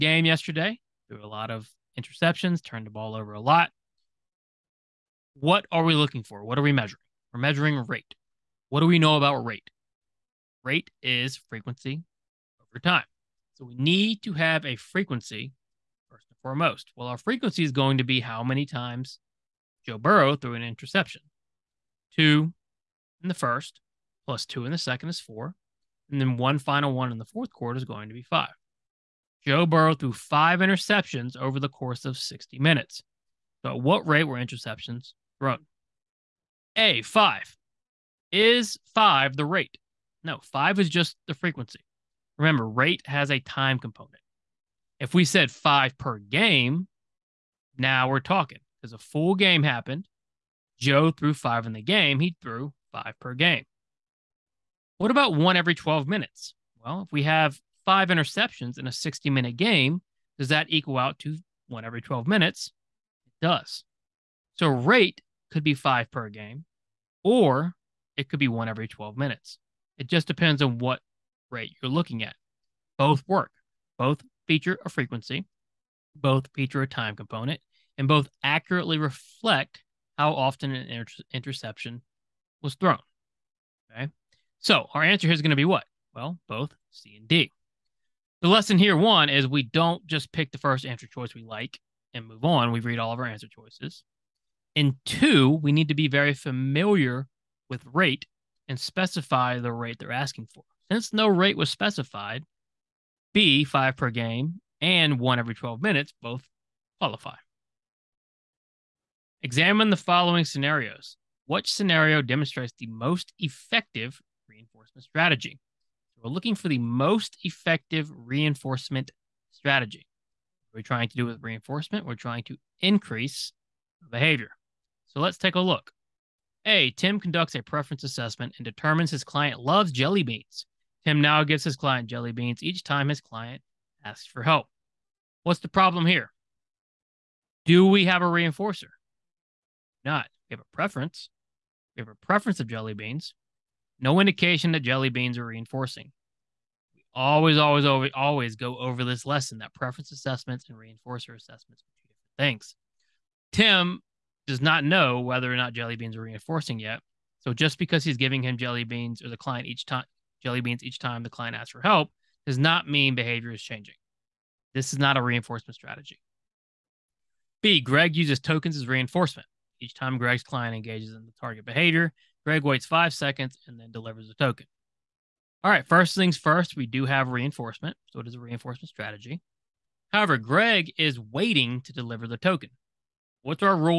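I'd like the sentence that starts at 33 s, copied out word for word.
So at what rate were interceptions thrown?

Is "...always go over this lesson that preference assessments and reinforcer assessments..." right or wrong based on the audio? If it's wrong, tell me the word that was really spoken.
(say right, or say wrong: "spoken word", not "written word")
right.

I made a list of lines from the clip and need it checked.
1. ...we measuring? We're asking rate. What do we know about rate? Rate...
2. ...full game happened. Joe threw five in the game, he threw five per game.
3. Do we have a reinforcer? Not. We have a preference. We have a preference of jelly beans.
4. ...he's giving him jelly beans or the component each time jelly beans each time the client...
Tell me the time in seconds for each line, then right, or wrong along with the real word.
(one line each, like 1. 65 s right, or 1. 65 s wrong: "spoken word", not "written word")
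1. 6 s wrong: "measuring", not "asking"
2. 48 s right
3. 137 s right
4. 158 s wrong: "client", not "component".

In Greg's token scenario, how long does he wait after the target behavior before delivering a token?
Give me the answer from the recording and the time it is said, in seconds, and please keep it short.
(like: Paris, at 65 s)
5 seconds, at 172 s.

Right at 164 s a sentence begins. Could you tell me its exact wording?
This is not a reinforcement strategy.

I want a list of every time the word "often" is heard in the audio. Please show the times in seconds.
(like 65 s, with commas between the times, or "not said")
80 s.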